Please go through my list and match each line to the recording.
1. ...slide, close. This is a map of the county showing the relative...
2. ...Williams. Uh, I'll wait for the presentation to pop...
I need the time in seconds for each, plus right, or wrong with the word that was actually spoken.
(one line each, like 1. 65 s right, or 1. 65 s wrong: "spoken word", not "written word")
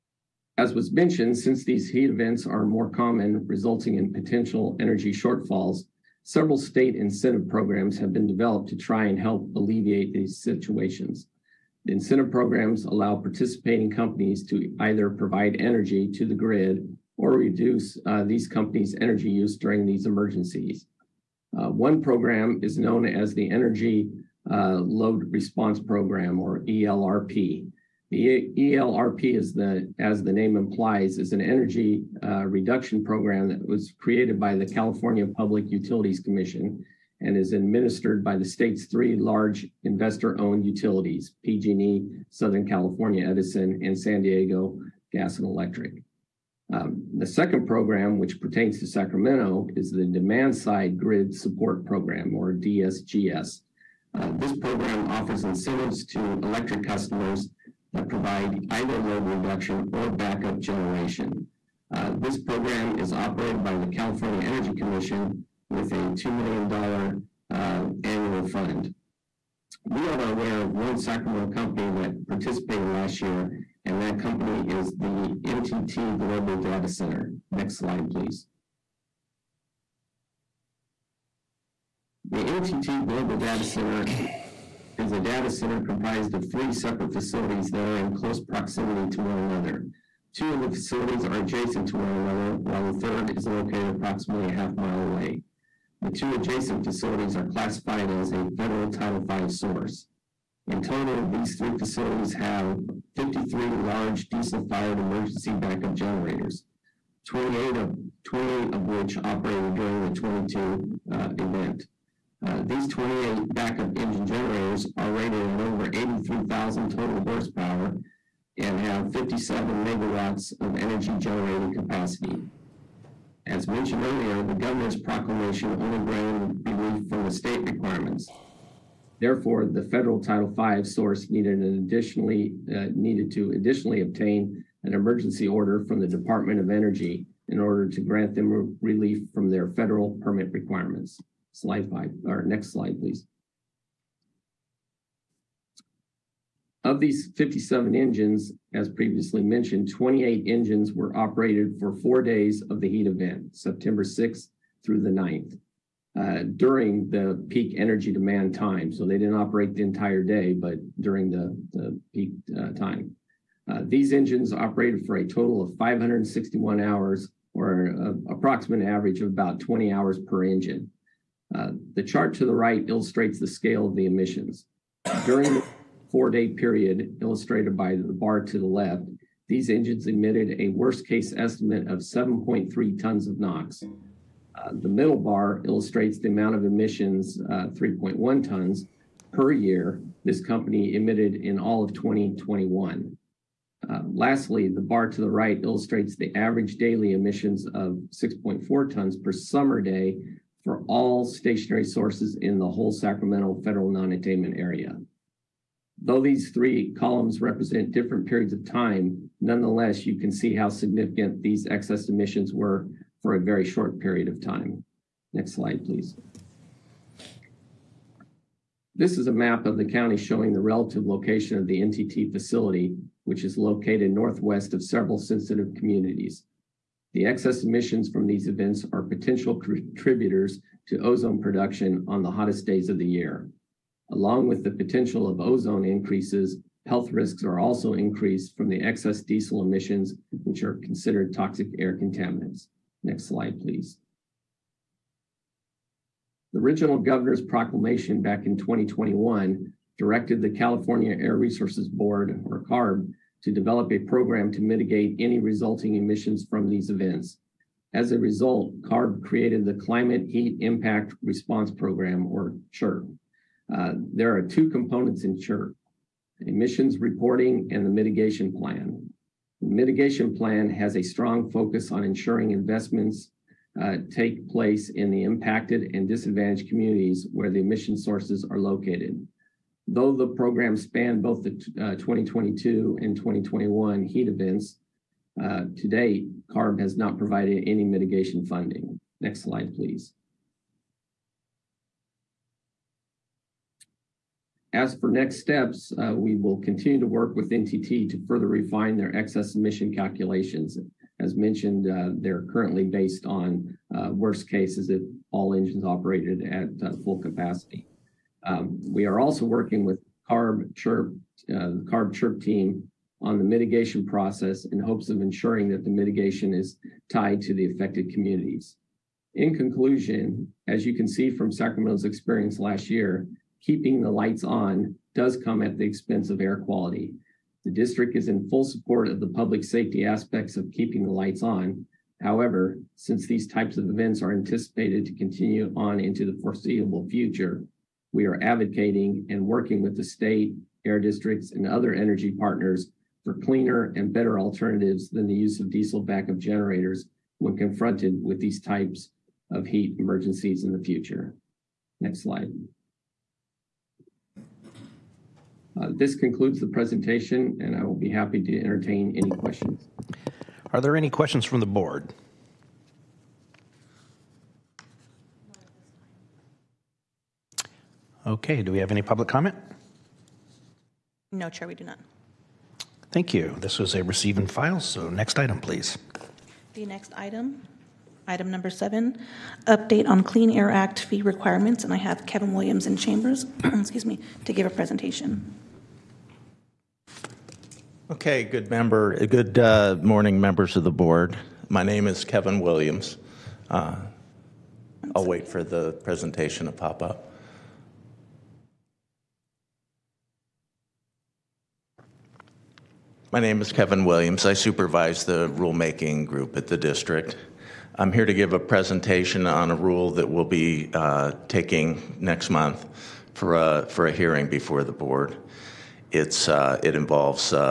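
1. 215 s wrong: "please", not "close"
2. 392 s right.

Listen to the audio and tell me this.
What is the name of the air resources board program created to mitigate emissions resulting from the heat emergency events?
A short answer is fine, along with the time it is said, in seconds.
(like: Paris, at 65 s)
Climate Heat Impact Response Program, at 259 s.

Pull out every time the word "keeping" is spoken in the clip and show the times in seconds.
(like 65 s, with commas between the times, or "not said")
323 s, 330 s.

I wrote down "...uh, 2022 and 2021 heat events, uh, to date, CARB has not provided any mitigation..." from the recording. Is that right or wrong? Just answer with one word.
right.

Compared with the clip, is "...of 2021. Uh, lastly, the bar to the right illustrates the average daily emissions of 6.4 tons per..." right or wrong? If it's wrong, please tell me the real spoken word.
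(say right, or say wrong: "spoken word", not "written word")
right.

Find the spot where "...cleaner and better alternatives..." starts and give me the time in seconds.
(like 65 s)
343 s.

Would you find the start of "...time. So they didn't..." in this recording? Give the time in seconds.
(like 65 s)
158 s.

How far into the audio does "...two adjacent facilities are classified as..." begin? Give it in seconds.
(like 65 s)
96 s.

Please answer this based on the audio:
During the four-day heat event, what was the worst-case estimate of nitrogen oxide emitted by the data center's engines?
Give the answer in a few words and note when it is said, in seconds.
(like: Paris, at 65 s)
7.3 tons, at 181 s.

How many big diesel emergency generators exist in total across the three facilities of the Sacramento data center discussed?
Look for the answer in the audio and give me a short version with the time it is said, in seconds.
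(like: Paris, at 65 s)
53, at 103 s.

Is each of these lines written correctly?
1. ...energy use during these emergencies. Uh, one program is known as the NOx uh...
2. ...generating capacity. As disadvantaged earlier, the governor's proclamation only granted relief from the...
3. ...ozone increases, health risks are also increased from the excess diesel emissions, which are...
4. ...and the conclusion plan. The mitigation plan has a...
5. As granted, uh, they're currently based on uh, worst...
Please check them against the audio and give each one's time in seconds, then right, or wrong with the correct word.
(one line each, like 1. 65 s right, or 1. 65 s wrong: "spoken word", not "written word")
1. 19 s wrong: "Energy", not "NOx"
2. 121 s wrong: "mentioned", not "disadvantaged"
3. 235 s right
4. 267 s wrong: "mitigation", not "conclusion"
5. 301 s wrong: "mentioned", not "granted".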